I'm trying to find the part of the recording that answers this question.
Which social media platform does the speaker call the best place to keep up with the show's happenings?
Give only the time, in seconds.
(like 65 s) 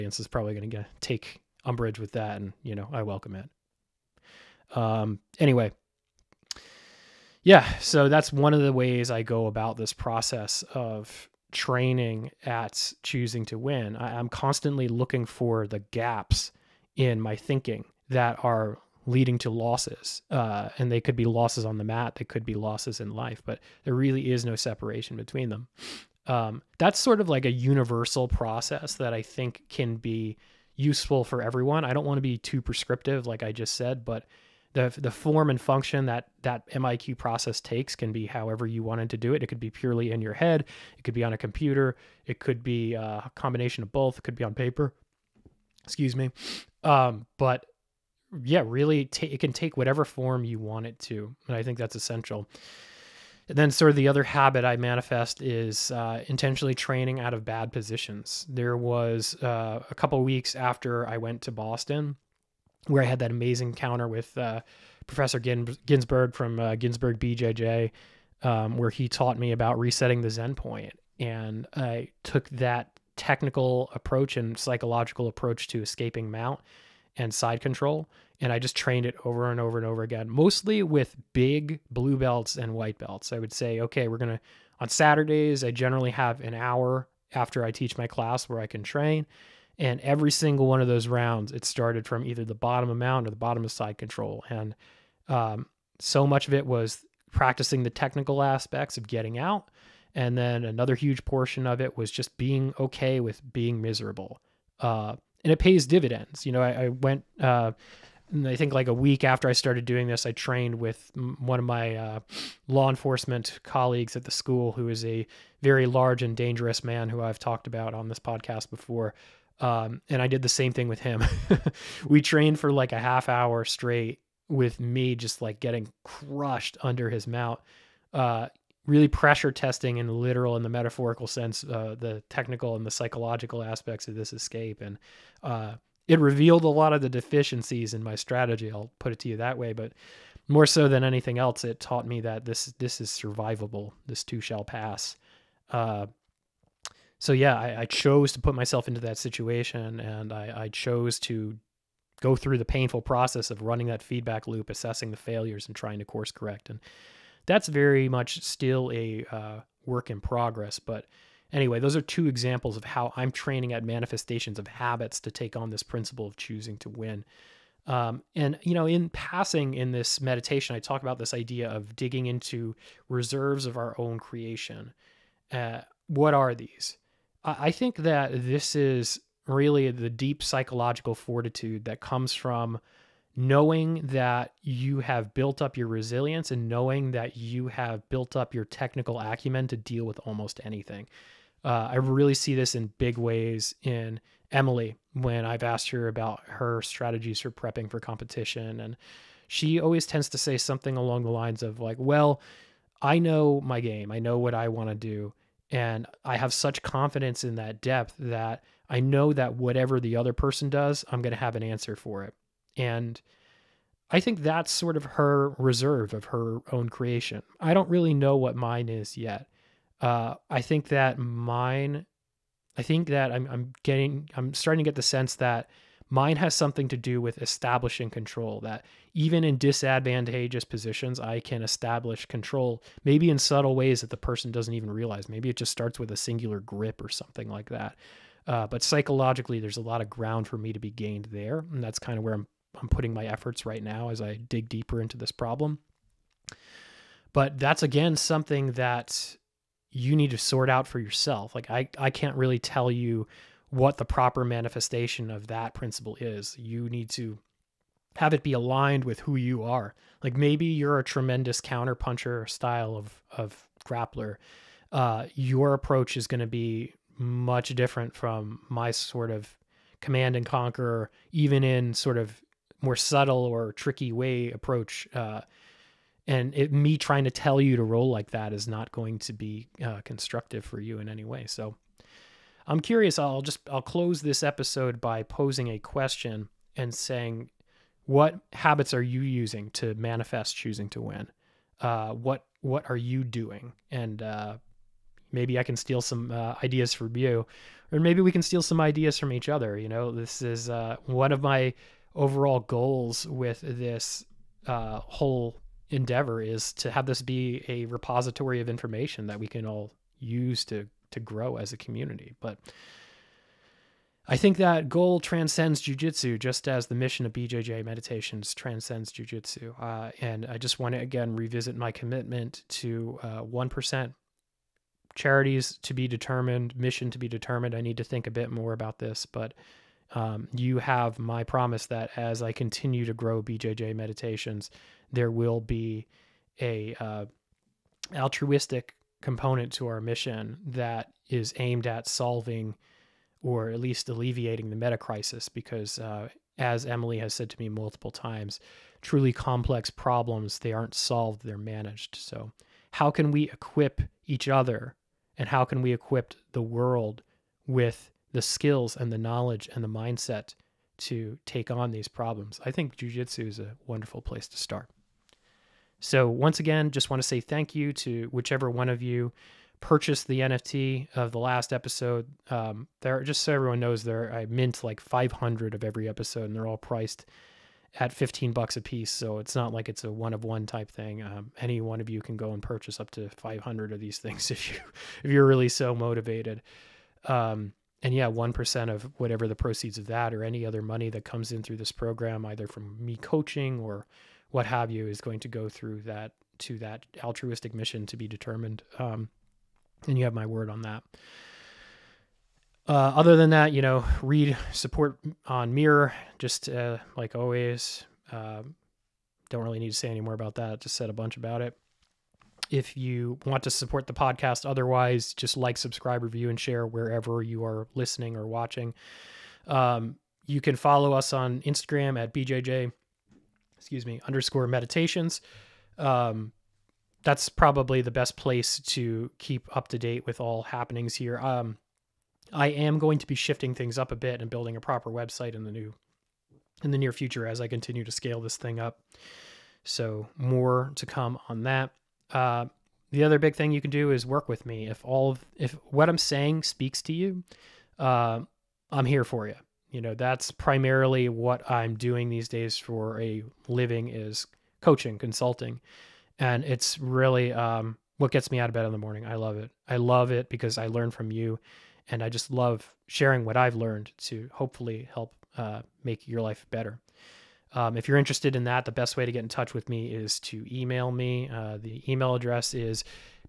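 421 s.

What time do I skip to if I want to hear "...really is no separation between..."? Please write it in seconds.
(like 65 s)
23 s.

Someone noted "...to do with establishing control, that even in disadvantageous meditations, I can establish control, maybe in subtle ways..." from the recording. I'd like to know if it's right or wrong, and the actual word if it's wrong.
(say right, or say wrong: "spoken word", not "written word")
wrong: "positions", not "meditations".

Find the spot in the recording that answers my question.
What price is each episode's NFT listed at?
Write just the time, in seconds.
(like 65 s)
378 s.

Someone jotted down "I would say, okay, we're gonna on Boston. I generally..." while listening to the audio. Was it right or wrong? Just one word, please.
wrong.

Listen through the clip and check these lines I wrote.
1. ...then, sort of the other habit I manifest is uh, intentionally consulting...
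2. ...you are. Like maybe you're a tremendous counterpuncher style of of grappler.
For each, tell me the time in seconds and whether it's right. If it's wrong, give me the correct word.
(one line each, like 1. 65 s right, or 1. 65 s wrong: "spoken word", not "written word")
1. 53 s wrong: "training", not "consulting"
2. 259 s right.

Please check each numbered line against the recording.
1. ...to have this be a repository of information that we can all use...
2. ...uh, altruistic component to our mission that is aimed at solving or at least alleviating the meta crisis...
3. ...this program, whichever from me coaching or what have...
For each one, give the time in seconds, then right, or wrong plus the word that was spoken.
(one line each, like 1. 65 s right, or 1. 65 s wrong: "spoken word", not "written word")
1. 306 s right
2. 336 s right
3. 391 s wrong: "either", not "whichever".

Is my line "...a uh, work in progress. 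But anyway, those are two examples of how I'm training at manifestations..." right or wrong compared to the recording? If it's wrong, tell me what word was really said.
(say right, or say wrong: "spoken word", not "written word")
right.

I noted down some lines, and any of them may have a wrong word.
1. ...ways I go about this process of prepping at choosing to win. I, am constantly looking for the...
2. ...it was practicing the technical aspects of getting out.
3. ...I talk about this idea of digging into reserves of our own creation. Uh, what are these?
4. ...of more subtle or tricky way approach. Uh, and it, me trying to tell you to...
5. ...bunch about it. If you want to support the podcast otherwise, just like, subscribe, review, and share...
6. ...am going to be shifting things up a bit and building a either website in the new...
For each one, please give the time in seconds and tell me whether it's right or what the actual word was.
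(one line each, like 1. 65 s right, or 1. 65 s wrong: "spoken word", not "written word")
1. 8 s wrong: "training", not "prepping"
2. 96 s right
3. 170 s right
4. 272 s right
5. 411 s right
6. 432 s wrong: "proper", not "either".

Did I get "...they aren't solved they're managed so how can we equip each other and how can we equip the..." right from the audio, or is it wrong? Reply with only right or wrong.
right.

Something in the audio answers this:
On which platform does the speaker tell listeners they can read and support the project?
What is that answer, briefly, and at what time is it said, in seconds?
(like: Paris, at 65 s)
Mirror, at 405 s.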